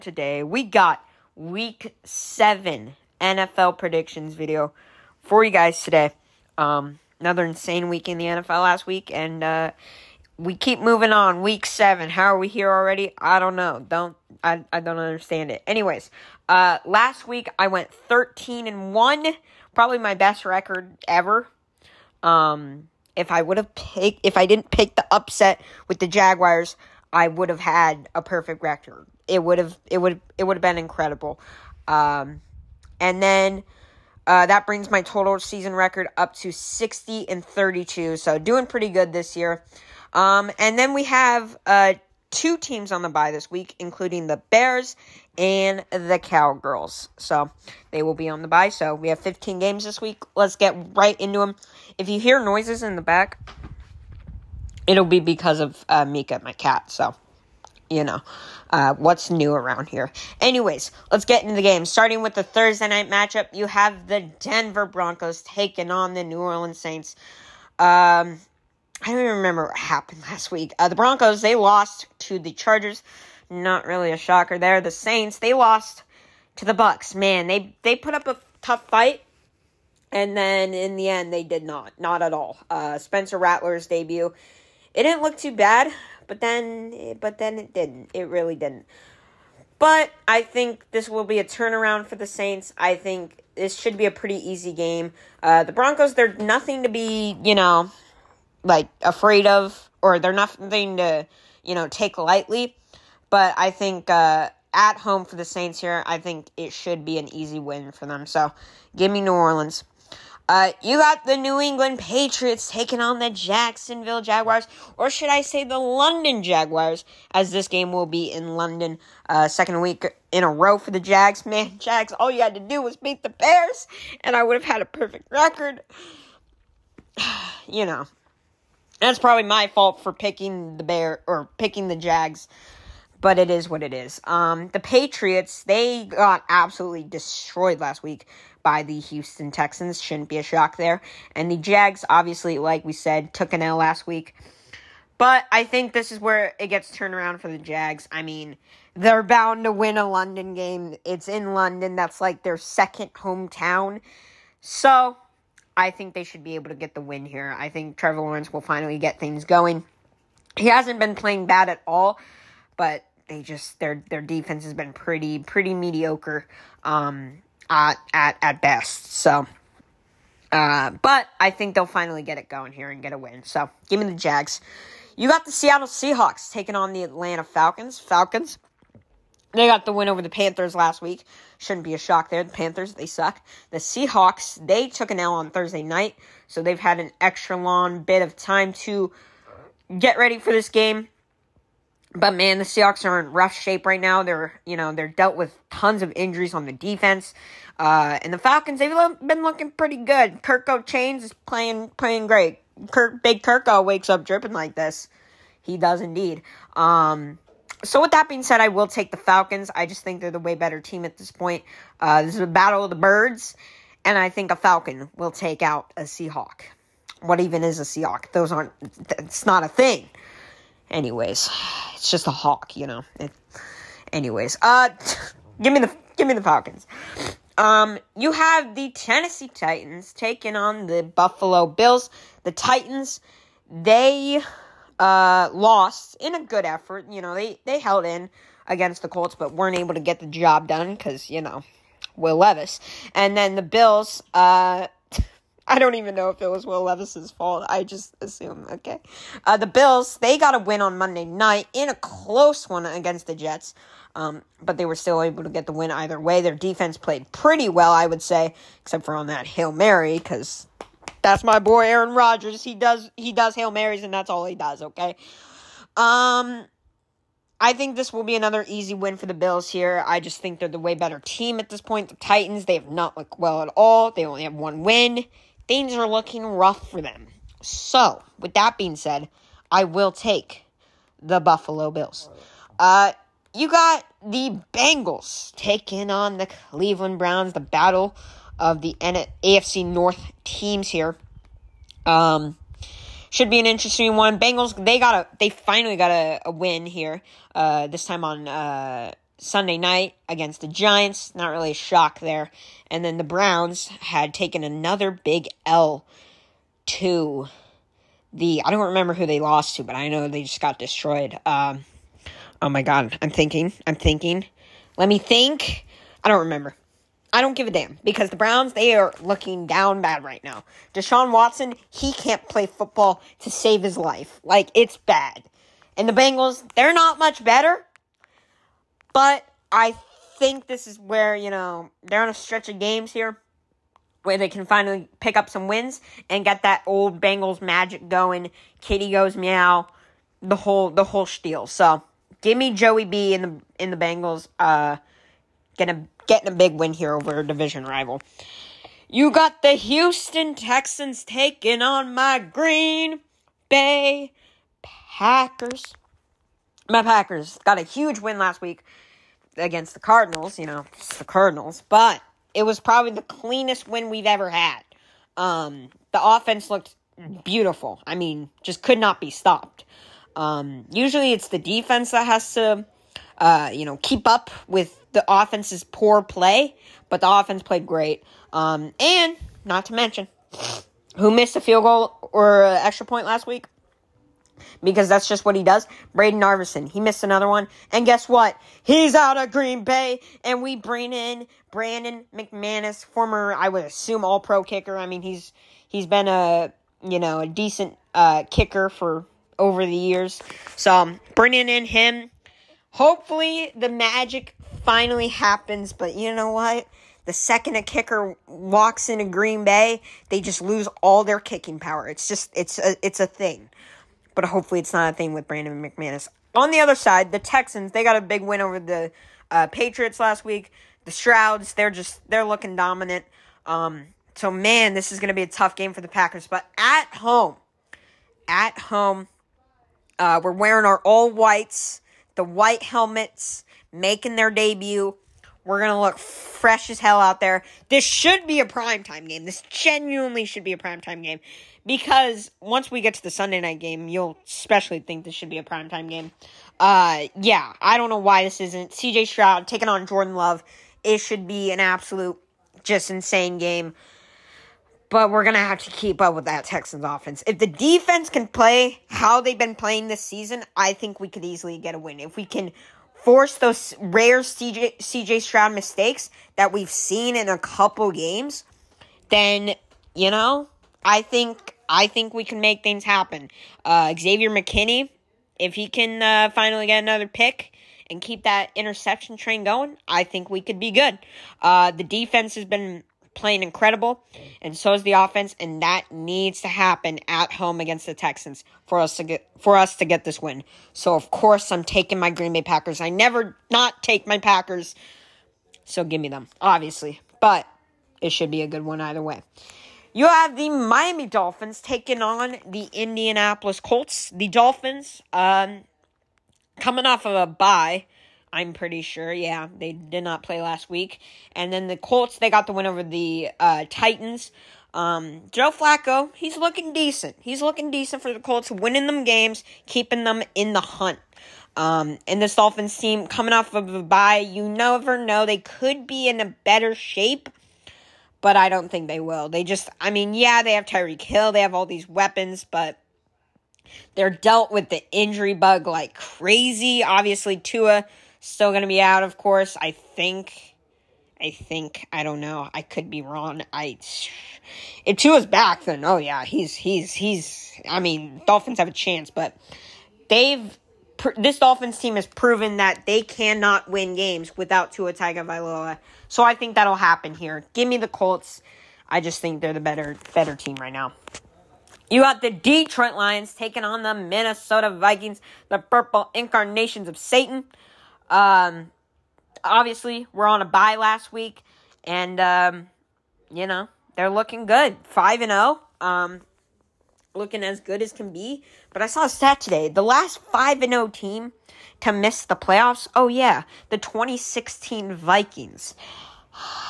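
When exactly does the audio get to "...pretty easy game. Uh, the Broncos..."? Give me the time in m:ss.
1:34.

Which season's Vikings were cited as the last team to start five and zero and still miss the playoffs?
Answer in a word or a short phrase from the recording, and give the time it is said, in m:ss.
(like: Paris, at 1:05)
2016, at 9:43.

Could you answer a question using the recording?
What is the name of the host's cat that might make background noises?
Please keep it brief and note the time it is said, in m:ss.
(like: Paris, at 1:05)
Mika, at 0:56.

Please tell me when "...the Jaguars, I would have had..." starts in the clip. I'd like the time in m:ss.
0:25.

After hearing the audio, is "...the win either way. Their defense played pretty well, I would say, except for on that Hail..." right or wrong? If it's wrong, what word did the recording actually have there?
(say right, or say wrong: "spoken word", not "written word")
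right.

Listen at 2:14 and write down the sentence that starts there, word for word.
Um, the Patriots, they got absolutely destroyed last week by the Houston Texans.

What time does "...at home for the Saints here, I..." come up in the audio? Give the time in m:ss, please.
1:44.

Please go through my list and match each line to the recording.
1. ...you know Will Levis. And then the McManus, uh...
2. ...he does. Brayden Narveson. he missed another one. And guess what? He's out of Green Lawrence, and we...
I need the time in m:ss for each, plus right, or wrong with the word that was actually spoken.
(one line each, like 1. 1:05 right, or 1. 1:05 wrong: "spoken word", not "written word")
1. 4:01 wrong: "Bills", not "McManus"
2. 6:25 wrong: "Bay", not "Lawrence".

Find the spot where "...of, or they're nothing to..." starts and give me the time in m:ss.
1:39.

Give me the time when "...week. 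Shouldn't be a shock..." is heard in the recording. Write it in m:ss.
3:00.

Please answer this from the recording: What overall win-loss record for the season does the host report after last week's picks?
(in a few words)
60 and 32.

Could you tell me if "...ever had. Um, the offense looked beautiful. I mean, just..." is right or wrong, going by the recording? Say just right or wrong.
right.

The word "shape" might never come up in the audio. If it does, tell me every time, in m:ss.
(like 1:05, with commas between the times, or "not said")
3:13, 8:46.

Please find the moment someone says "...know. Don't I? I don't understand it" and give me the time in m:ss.
0:13.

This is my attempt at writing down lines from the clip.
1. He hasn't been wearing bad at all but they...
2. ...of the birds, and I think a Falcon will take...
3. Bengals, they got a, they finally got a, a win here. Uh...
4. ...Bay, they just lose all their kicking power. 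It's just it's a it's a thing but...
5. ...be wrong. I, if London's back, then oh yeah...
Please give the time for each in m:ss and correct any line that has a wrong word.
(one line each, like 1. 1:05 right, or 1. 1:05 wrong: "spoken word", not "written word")
1. 2:40 wrong: "playing", not "wearing"
2. 3:32 right
3. 4:54 right
4. 6:49 right
5. 9:03 wrong: "Tua", not "London".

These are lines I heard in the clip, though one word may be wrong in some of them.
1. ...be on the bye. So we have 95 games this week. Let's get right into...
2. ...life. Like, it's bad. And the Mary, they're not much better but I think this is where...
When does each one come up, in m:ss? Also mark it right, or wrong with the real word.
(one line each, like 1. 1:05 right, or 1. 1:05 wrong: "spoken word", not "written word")
1. 0:48 wrong: "15", not "95"
2. 5:23 wrong: "Bengals", not "Mary".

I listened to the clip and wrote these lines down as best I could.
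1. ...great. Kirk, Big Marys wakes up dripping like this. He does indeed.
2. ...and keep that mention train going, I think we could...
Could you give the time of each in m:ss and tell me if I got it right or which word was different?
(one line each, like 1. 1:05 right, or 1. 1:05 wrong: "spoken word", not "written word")
1. 3:22 wrong: "Kirko", not "Marys"
2. 7:58 wrong: "interception", not "mention".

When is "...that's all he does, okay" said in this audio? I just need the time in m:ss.
4:24.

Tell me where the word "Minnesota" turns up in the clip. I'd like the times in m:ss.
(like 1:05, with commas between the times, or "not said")
9:24.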